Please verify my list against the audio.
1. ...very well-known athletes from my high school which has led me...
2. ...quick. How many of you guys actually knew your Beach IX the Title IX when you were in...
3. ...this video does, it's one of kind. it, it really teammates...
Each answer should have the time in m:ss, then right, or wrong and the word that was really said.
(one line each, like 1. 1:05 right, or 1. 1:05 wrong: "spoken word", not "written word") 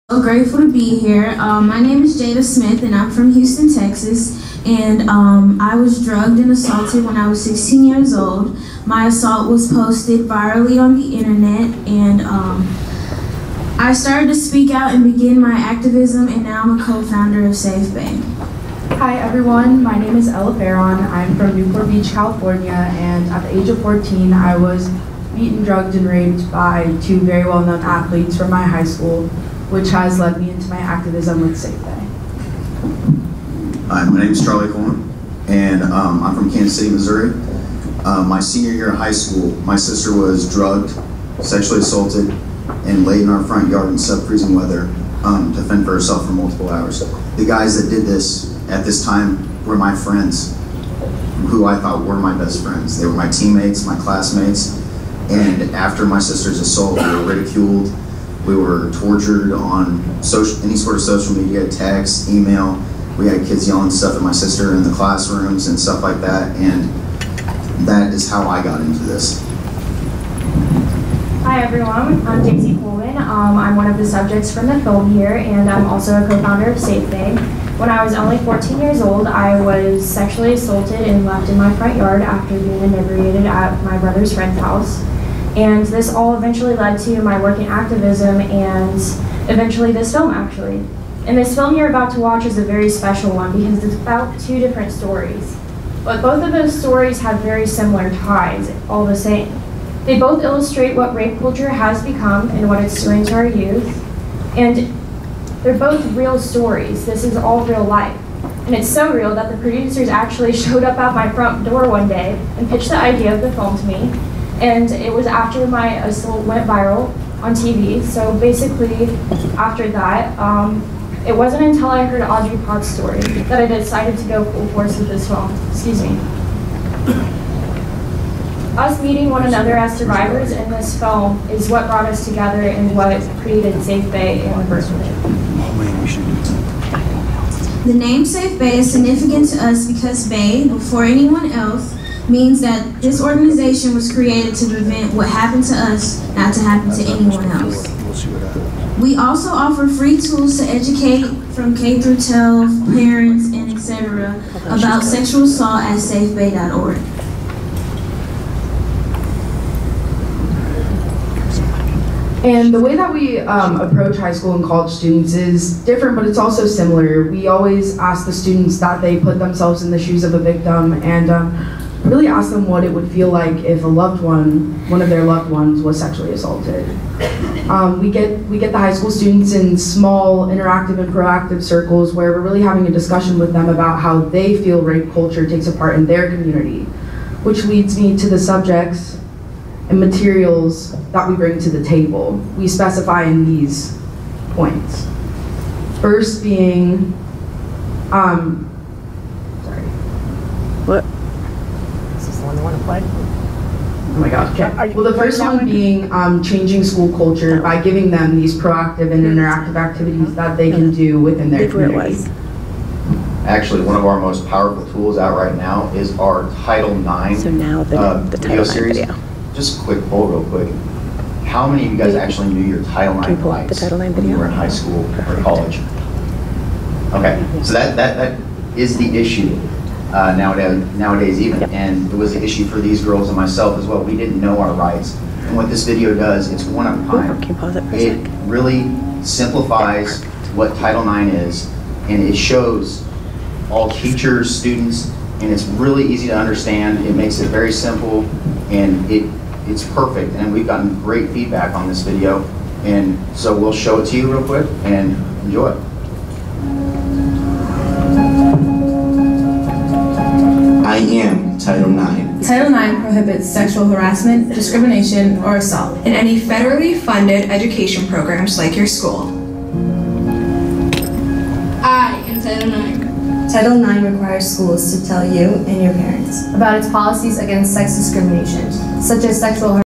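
1. 0:27 right
2. 3:40 wrong: "Title", not "Beach"
3. 3:55 wrong: "simplifies", not "teammates".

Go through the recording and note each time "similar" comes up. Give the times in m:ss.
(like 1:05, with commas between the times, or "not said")
1:37, 2:46.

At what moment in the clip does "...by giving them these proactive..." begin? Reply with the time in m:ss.
3:27.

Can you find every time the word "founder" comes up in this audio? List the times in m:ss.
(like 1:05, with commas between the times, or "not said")
0:16, 1:16.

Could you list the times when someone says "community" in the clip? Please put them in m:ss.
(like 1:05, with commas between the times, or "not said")
3:06, 3:31.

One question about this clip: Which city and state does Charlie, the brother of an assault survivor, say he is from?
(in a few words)
Kansas City, Missouri.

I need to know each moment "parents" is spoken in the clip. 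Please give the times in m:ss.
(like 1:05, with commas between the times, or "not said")
2:32, 4:35.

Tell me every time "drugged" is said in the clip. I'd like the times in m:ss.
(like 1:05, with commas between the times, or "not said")
0:06, 0:25, 0:40.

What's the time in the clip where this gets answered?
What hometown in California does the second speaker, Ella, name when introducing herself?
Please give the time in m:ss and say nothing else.
0:21.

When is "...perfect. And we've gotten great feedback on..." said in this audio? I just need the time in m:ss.
4:09.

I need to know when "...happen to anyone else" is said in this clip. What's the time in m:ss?
2:26.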